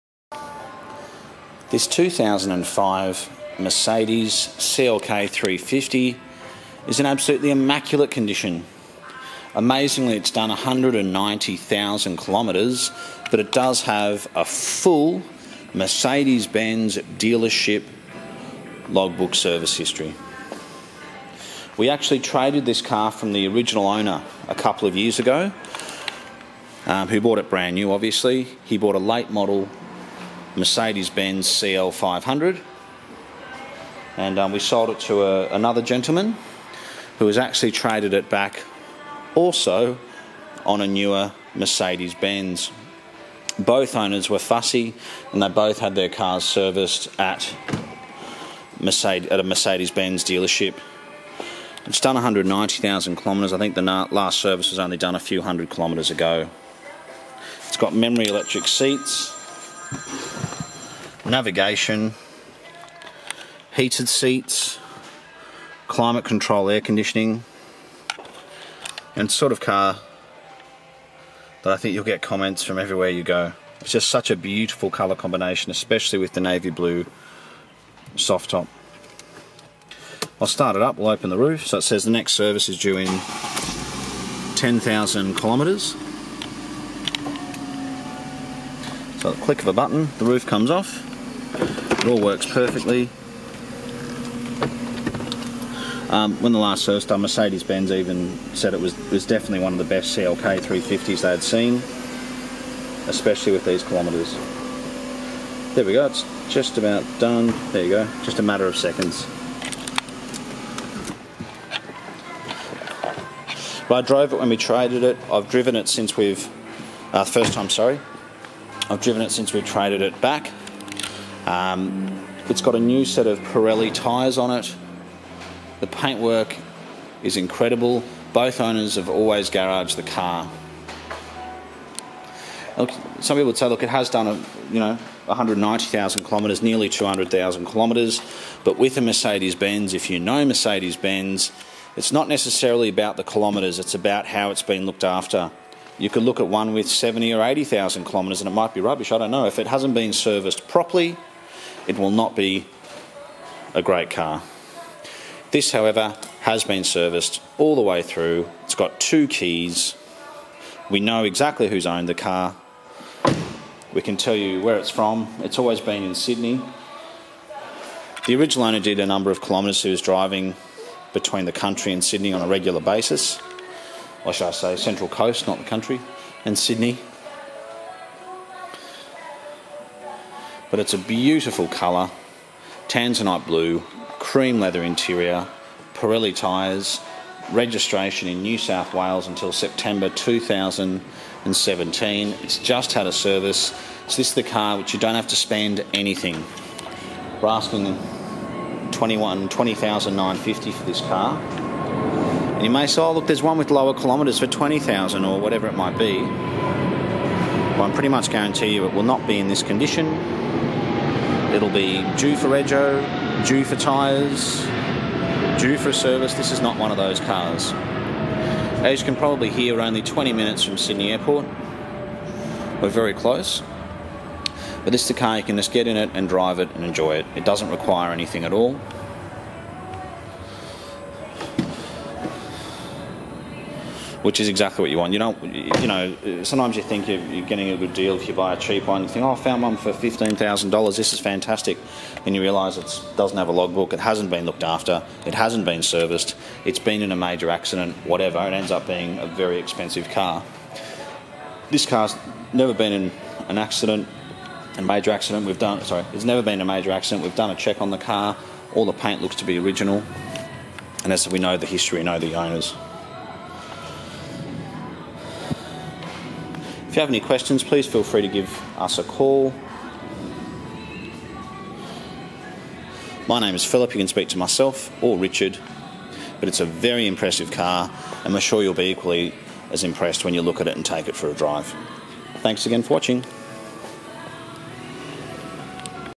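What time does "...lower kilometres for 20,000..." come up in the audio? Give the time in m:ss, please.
3:23.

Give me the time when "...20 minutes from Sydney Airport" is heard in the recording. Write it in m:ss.
3:40.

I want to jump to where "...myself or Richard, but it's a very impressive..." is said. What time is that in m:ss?
4:34.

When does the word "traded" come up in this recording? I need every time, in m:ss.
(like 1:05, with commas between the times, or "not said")
0:22, 0:37, 1:54, 1:59.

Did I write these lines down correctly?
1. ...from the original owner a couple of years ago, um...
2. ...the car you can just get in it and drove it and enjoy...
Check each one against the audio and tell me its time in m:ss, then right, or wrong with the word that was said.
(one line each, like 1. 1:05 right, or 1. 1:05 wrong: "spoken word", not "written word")
1. 0:23 right
2. 3:45 wrong: "drive", not "drove".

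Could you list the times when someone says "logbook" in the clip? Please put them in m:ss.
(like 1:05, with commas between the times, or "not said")
0:18, 4:03.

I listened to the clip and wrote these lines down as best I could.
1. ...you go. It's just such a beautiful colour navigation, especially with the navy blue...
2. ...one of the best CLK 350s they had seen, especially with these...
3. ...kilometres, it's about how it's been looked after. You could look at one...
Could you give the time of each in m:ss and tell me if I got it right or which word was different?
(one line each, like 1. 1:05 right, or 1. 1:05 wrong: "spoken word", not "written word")
1. 1:13 wrong: "combination", not "navigation"
2. 1:39 right
3. 2:23 right.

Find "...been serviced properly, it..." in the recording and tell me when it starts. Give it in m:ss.
2:29.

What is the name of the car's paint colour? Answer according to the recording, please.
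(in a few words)
Tanzanite blue.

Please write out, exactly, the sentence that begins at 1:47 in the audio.
There you go, just a matter of seconds.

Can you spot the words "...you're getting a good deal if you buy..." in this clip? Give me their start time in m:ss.
3:57.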